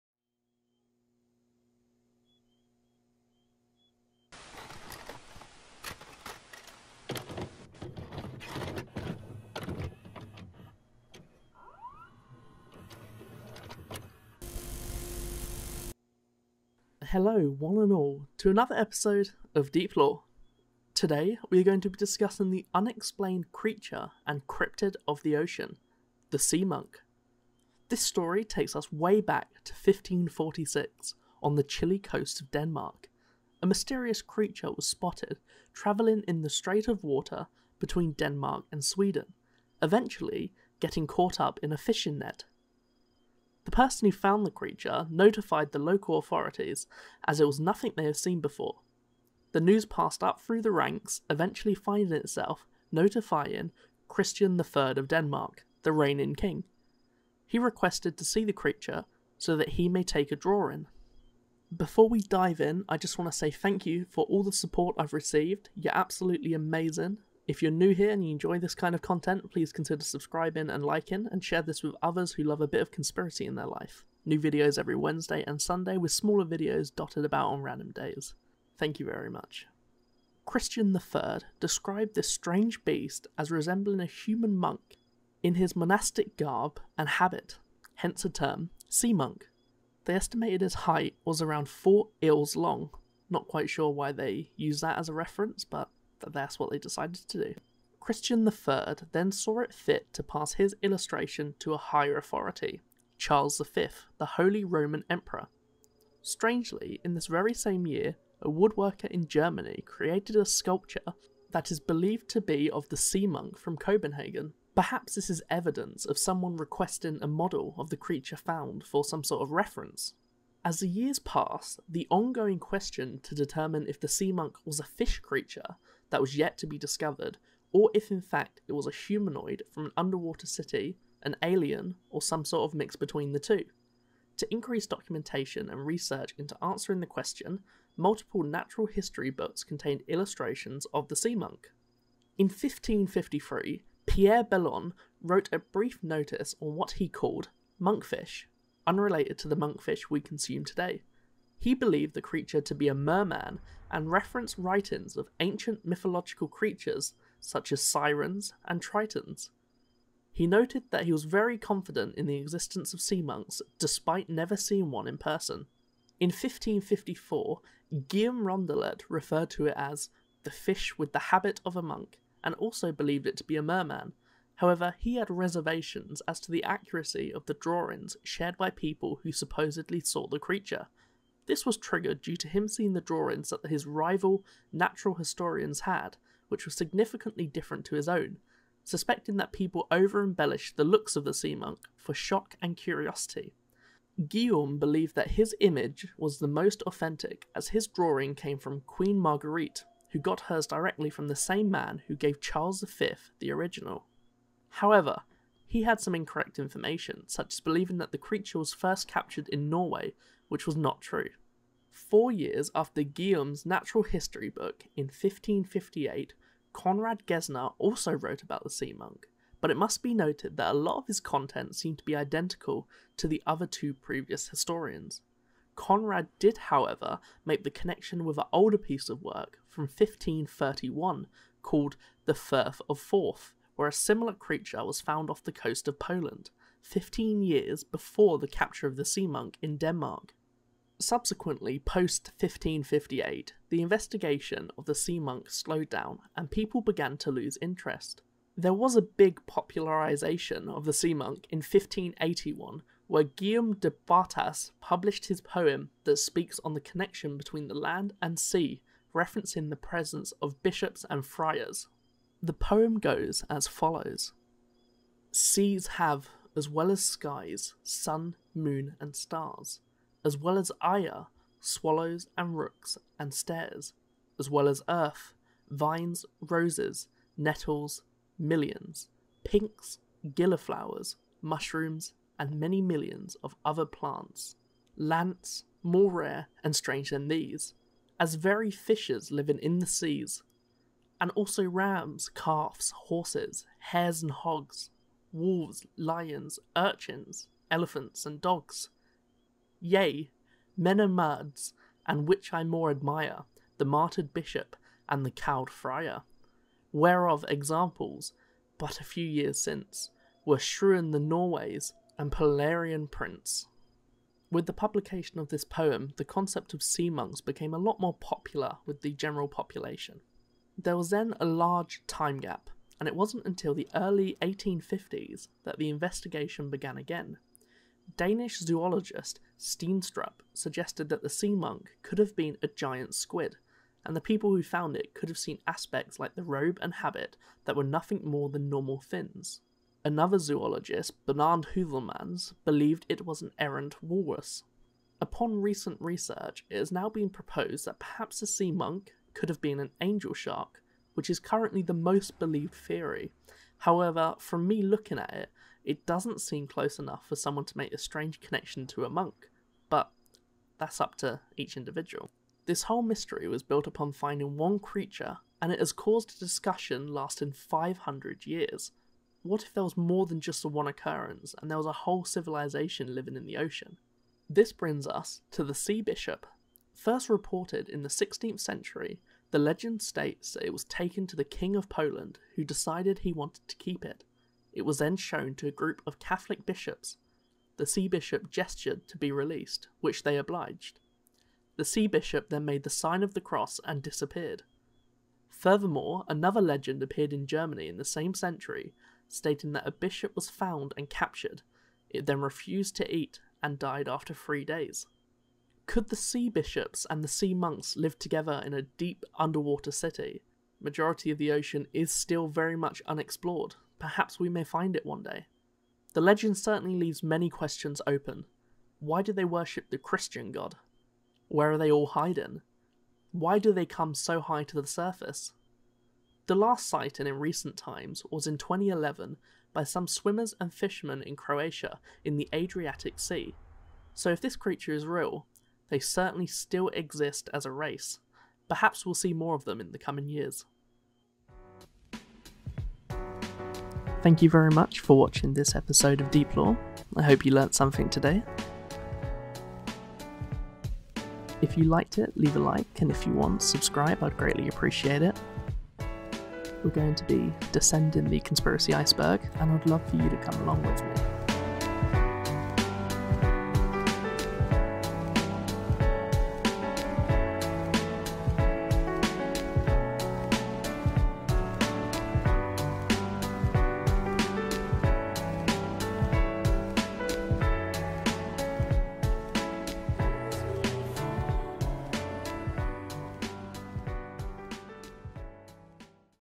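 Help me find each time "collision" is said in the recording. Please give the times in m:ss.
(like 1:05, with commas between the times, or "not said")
not said.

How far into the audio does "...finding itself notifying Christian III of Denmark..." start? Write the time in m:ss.
0:51.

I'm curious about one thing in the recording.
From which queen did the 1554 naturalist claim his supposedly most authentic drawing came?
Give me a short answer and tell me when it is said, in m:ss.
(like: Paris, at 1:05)
Queen Marguerite, at 3:18.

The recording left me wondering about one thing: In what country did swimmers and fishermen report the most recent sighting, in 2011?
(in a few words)
Croatia.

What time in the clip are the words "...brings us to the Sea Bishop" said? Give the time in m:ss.
6:14.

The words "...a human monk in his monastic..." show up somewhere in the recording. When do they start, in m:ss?
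1:23.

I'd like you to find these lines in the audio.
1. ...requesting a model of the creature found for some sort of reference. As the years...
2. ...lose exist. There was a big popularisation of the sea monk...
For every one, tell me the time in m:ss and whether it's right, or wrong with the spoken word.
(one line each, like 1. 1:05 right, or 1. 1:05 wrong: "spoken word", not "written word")
1. 1:56 right
2. 4:07 wrong: "interest", not "exist".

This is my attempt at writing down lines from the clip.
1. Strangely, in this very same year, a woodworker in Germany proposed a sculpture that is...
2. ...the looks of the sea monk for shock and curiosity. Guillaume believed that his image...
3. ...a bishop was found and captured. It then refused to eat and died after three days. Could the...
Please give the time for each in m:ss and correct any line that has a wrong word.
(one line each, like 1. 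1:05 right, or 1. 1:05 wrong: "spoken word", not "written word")
1. 1:46 wrong: "created", not "proposed"
2. 3:10 right
3. 6:39 right.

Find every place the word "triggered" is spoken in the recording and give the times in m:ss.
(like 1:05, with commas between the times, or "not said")
3:01.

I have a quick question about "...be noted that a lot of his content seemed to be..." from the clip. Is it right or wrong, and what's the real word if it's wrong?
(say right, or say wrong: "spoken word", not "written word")
right.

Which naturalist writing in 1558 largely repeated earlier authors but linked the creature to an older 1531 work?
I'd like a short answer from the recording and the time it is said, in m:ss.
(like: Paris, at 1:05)
Conrad Gesner, at 3:36.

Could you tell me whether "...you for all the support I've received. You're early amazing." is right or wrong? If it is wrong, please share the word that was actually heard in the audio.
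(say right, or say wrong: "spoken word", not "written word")
wrong: "absolutely", not "early".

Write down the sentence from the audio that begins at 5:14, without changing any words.
With the publication of this poem, the concept of sea monks became a lot more popular with the general population.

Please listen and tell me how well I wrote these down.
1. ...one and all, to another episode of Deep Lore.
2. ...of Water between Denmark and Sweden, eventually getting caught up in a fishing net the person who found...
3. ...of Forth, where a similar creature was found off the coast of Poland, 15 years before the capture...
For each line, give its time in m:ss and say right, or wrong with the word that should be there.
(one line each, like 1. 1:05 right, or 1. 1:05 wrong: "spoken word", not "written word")
1. 0:17 right
2. 0:36 right
3. 3:52 right.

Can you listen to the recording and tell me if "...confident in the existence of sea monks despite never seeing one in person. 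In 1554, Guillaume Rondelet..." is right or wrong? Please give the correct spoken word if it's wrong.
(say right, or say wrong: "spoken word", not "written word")
right.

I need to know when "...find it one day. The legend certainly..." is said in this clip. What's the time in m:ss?
6:54.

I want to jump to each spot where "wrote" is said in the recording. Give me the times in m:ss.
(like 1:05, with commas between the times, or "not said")
2:25, 3:38.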